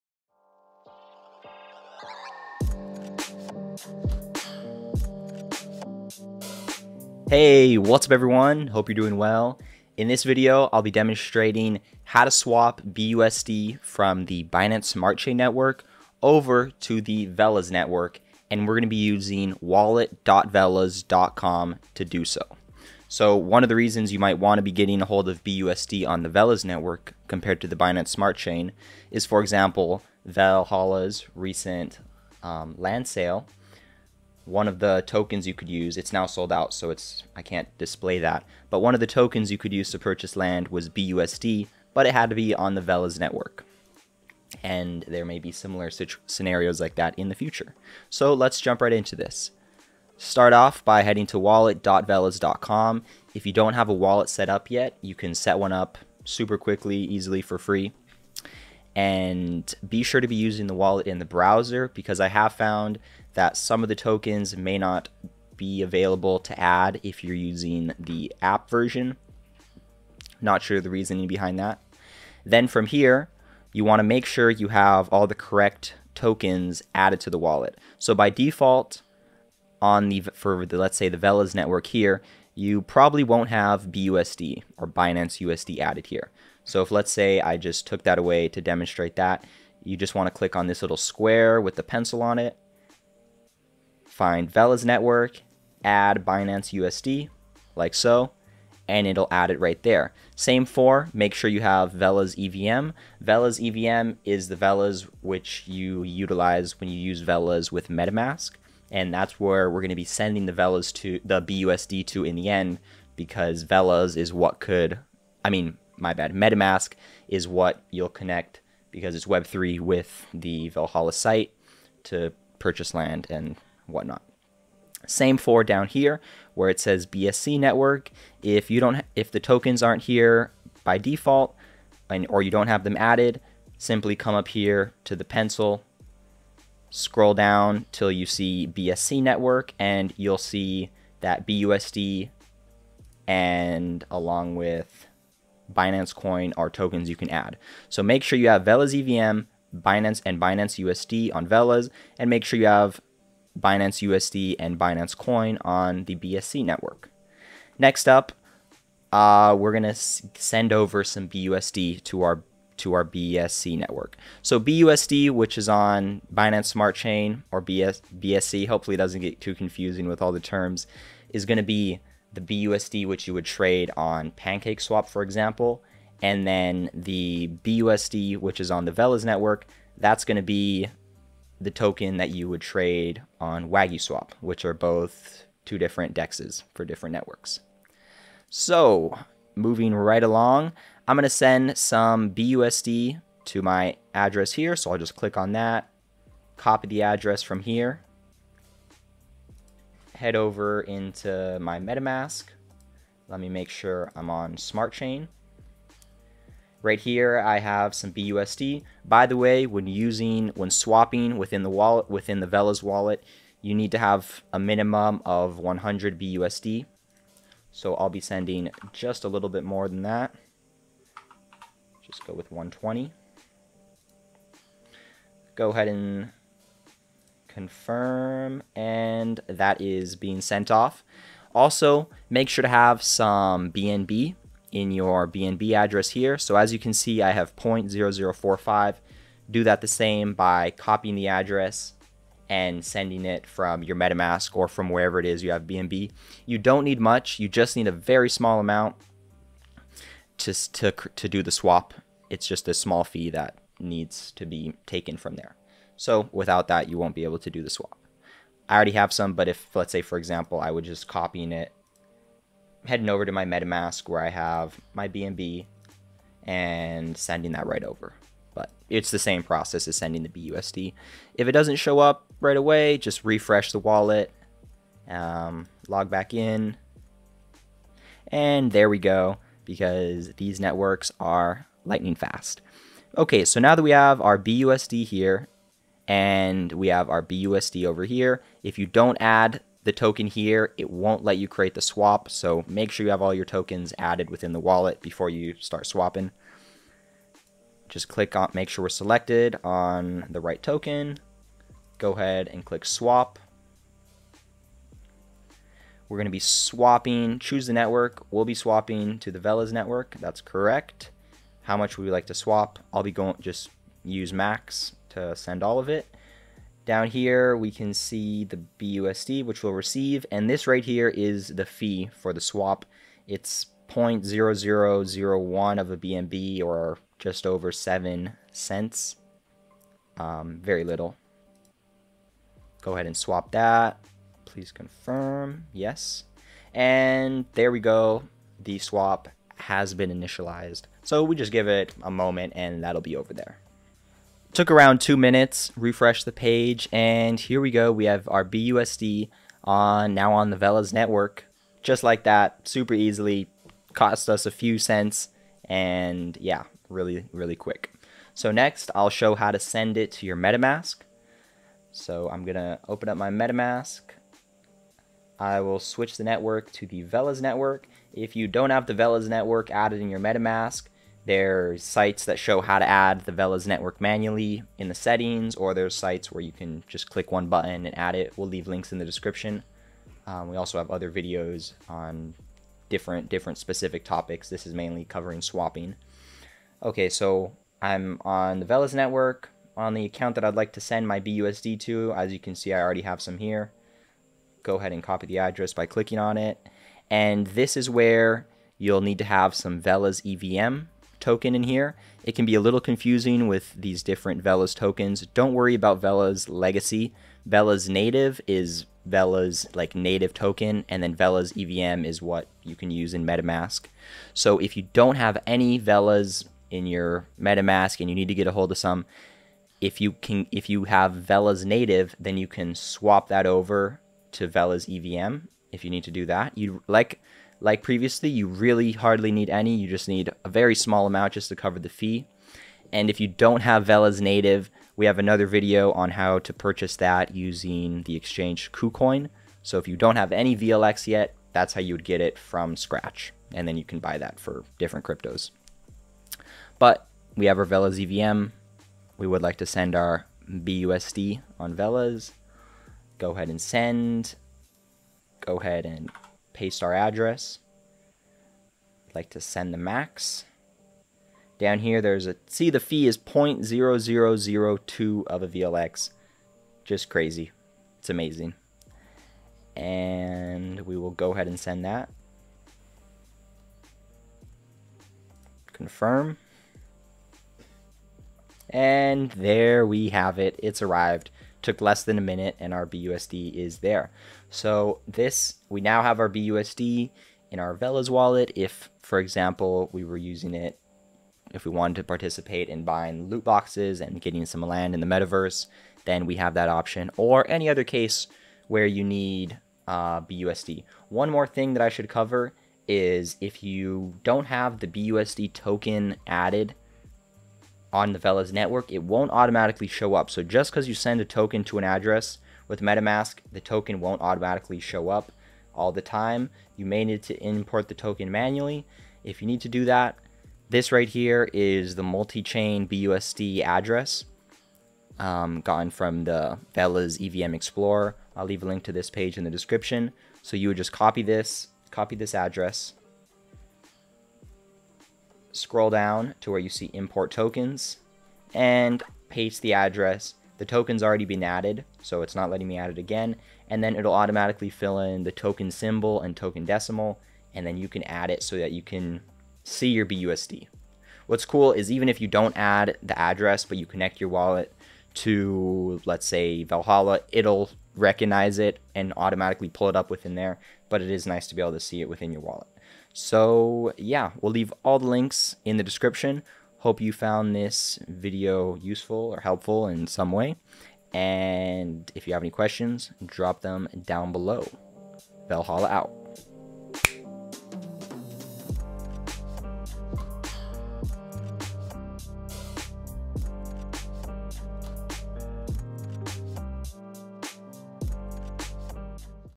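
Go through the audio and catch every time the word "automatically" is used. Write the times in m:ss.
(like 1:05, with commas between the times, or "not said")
8:29, 8:34, 9:04, 9:19.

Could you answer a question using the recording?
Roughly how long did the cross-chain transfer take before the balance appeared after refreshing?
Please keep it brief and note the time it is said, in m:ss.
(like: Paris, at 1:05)
two minutes, at 5:44.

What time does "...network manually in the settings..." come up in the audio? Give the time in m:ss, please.
6:13.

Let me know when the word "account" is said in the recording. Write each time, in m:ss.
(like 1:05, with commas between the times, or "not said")
6:30.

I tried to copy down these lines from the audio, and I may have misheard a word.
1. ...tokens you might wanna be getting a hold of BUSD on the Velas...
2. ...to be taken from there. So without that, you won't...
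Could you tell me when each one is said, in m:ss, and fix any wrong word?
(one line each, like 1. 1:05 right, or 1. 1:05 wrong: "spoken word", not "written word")
1. 0:23 wrong: "reasons", not "tokens"
2. 4:14 right.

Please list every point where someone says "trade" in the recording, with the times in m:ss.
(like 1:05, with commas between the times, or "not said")
2:53, 3:02.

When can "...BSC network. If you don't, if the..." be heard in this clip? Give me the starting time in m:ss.
2:07.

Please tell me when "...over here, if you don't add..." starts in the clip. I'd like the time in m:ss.
4:47.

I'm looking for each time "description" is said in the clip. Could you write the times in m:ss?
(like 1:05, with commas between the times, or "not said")
6:19, 8:49, 9:25.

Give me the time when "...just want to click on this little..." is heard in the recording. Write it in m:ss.
1:29.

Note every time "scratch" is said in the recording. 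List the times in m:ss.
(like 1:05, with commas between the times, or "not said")
7:22.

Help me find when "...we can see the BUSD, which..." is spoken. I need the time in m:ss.
5:17.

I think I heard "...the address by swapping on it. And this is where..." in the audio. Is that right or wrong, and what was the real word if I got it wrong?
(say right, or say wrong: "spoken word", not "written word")
wrong: "clicking", not "swapping".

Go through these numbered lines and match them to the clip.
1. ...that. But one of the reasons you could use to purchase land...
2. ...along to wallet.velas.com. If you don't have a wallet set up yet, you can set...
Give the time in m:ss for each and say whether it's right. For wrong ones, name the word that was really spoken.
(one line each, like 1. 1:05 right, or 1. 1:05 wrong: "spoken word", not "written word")
1. 0:38 wrong: "tokens", not "reasons"
2. 0:51 wrong: "heading", not "along".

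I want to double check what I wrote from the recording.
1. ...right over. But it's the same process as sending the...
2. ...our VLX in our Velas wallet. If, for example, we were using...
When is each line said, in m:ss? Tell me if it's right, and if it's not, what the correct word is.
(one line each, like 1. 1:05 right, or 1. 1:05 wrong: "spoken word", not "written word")
1. 4:27 right
2. 8:06 wrong: "BUSD", not "VLX".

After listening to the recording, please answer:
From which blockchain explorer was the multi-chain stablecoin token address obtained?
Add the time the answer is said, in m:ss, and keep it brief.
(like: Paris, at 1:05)
Velas EVM Explorer, at 8:46.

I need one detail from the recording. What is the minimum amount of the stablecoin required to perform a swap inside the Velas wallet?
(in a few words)
100 BUSD.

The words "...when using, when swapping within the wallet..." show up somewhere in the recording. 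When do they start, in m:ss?
3:29.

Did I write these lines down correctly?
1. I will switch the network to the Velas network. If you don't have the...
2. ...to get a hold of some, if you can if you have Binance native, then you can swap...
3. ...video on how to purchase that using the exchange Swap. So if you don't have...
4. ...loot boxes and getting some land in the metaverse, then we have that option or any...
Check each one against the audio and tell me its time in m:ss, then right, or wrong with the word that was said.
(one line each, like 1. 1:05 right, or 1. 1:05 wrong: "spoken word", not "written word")
1. 6:05 right
2. 6:58 wrong: "Velas", not "Binance"
3. 7:15 wrong: "KuCoin", not "Swap"
4. 8:13 right.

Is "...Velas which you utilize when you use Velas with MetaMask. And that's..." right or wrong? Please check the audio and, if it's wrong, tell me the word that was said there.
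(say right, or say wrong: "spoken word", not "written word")
right.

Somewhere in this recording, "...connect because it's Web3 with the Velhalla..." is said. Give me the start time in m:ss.
1:58.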